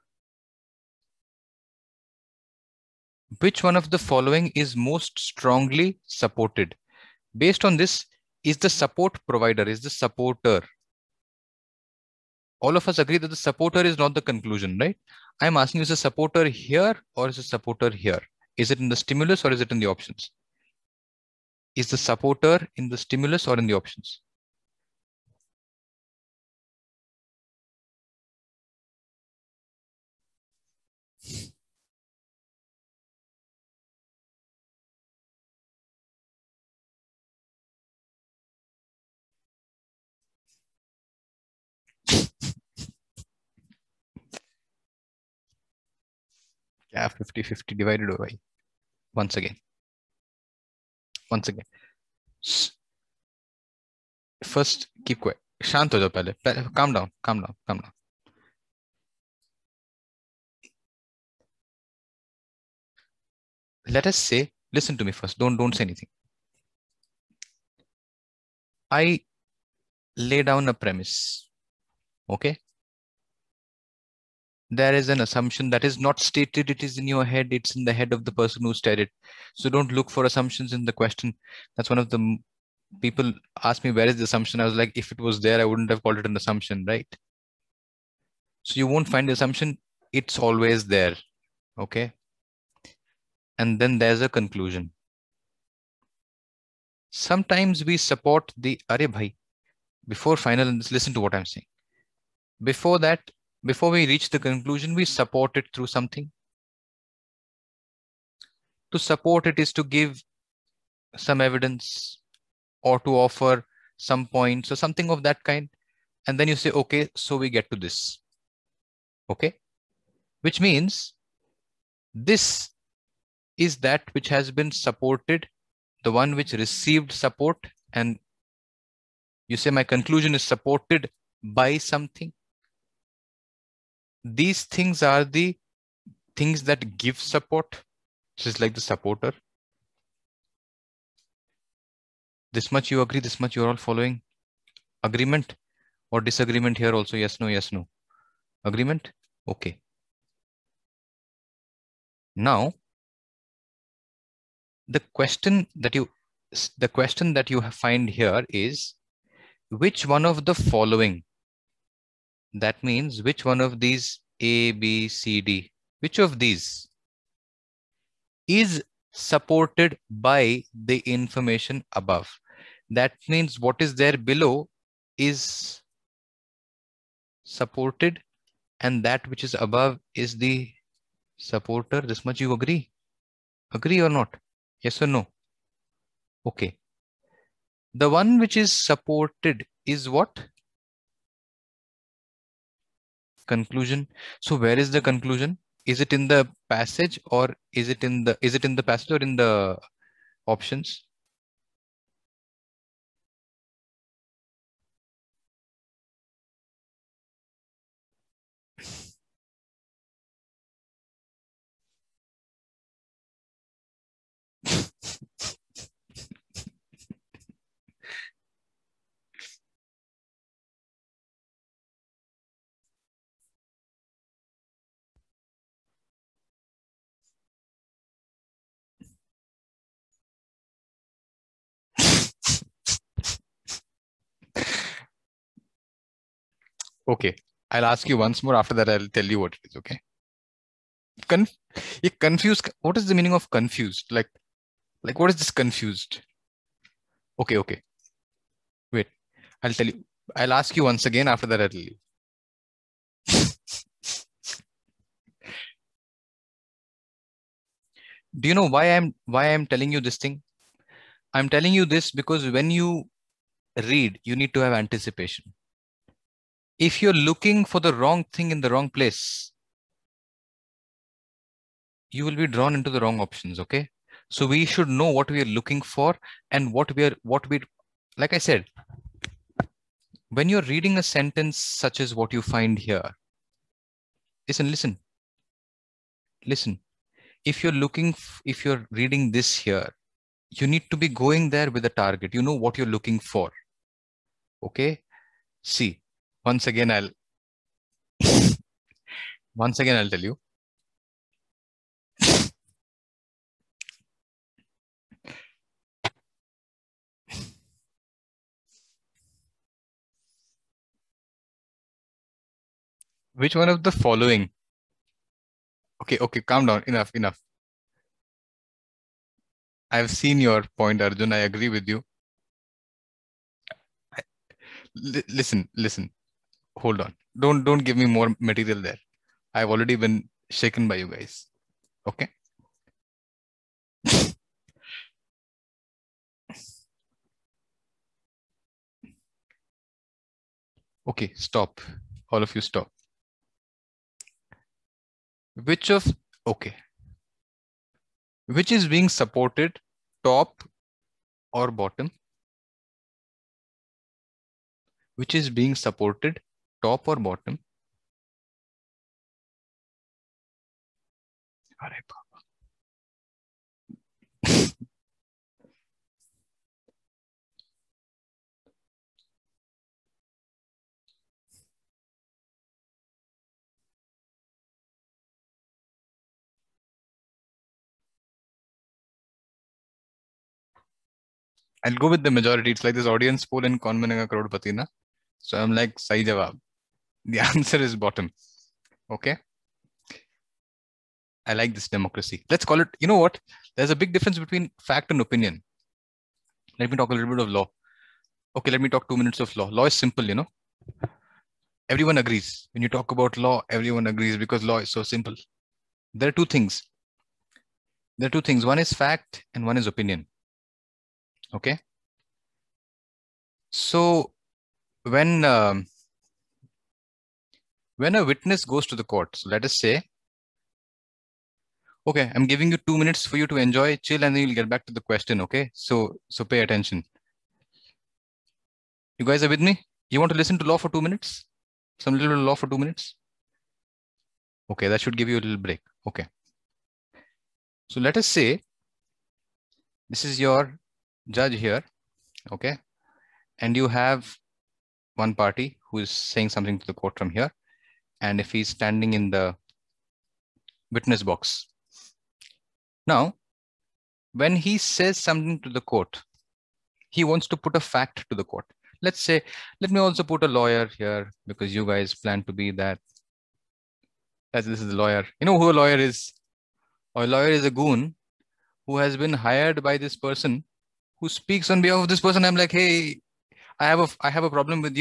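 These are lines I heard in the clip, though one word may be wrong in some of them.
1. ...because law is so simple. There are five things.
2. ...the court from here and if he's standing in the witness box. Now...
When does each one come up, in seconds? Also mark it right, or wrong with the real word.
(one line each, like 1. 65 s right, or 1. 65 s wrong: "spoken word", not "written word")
1. 404 s wrong: "two", not "five"
2. 446 s right.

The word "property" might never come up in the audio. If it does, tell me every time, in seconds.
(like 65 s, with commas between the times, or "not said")
not said.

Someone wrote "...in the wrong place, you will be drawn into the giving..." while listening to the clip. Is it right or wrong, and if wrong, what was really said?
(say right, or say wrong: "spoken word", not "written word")
wrong: "wrong", not "giving".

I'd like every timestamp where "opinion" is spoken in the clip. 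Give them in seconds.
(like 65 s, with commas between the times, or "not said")
395 s, 409 s.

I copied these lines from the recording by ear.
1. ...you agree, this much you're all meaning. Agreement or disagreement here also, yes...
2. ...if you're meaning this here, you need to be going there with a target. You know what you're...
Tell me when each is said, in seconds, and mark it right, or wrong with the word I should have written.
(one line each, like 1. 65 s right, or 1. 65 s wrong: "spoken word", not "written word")
1. 142 s wrong: "following", not "meaning"
2. 288 s wrong: "reading", not "meaning".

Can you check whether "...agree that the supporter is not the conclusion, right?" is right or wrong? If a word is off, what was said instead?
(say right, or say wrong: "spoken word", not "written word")
right.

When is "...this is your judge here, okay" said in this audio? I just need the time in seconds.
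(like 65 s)
440 s.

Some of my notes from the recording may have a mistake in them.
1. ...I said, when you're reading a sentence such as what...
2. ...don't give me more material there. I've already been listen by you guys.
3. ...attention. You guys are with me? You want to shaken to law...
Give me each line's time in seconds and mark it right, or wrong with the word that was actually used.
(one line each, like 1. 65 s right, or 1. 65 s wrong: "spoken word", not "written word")
1. 278 s right
2. 327 s wrong: "shaken", not "listen"
3. 426 s wrong: "listen", not "shaken".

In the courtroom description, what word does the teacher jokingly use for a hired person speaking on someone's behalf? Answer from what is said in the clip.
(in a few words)
goon.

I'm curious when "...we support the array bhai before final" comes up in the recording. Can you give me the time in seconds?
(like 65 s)
97 s.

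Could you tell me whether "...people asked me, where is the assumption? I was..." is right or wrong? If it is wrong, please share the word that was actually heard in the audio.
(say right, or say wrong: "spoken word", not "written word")
right.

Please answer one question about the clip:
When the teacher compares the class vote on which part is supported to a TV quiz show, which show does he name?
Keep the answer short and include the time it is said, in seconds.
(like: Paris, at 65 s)
Kaun Banega Crorepati, at 383 s.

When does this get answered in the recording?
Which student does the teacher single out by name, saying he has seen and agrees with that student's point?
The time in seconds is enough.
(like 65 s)
321 s.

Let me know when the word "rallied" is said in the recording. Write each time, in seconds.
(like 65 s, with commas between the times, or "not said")
not said.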